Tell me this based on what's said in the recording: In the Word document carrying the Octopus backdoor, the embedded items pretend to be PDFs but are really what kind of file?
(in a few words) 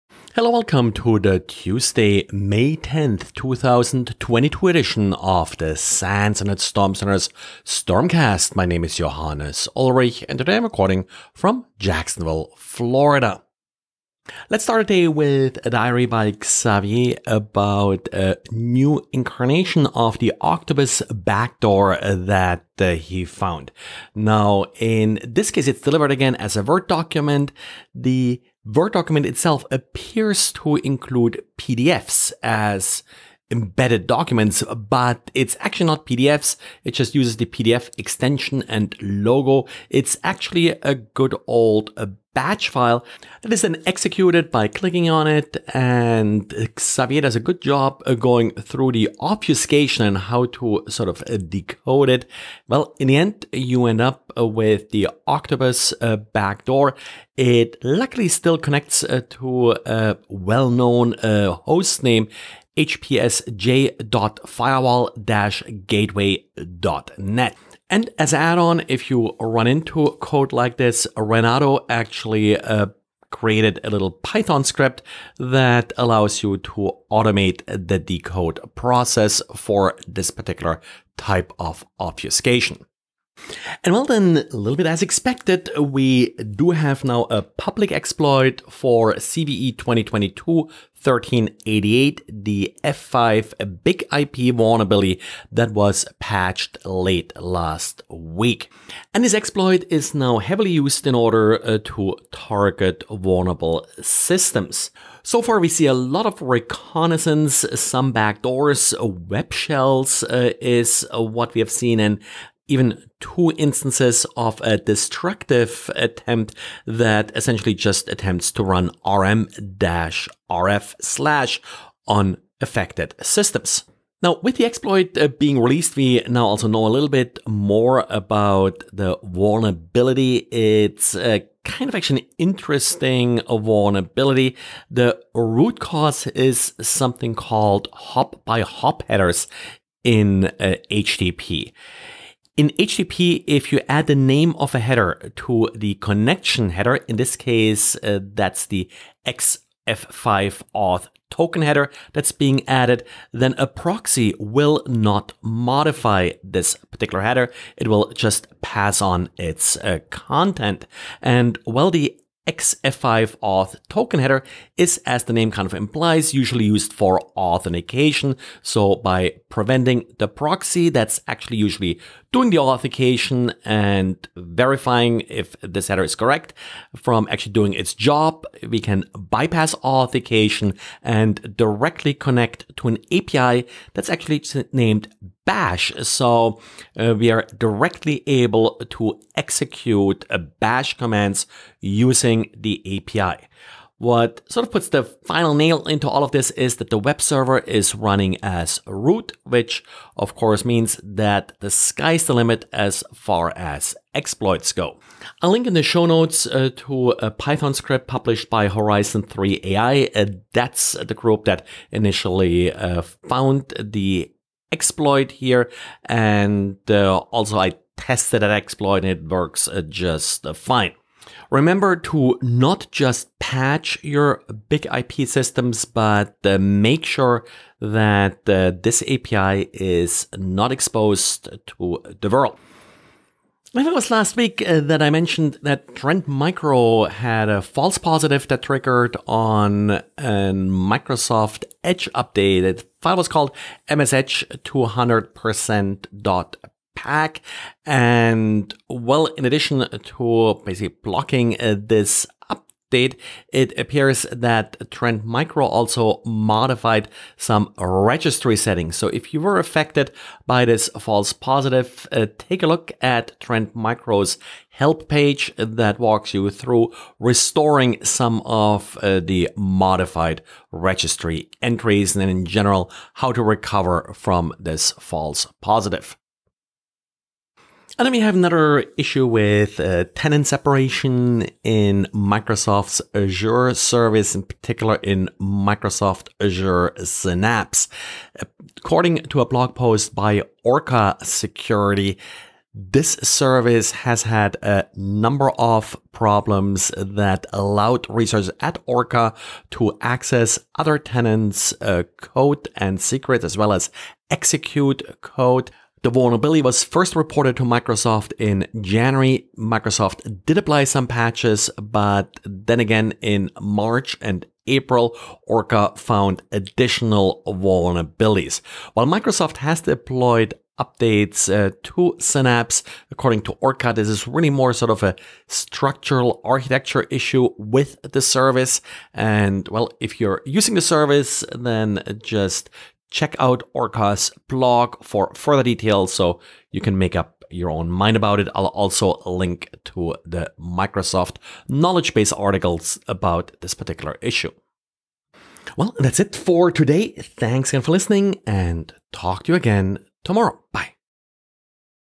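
batch file.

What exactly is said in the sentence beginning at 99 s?
And this exploit is now heavily used in order uh, to target vulnerable systems.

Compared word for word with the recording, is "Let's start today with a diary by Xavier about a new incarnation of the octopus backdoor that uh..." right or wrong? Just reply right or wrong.
right.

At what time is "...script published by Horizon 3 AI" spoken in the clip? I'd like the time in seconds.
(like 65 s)
207 s.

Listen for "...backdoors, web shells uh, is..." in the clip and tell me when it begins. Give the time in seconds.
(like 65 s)
108 s.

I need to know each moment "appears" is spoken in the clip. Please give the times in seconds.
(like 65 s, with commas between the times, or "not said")
29 s, 253 s.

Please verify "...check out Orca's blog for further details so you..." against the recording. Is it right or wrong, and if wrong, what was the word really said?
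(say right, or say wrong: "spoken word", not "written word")
right.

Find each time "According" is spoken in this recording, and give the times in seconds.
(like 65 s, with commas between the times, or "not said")
288 s, 323 s.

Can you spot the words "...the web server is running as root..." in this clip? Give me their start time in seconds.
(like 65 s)
196 s.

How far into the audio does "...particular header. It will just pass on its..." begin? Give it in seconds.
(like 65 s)
156 s.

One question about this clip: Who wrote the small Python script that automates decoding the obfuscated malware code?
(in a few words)
Renato.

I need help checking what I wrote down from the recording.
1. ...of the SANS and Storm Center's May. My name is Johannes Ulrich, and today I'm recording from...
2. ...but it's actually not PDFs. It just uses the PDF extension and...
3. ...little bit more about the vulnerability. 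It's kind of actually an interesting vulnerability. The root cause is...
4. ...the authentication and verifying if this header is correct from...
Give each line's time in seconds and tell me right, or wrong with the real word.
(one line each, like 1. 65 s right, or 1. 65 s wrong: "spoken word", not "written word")
1. 5 s wrong: "Stormcast", not "May"
2. 34 s right
3. 126 s right
4. 172 s right.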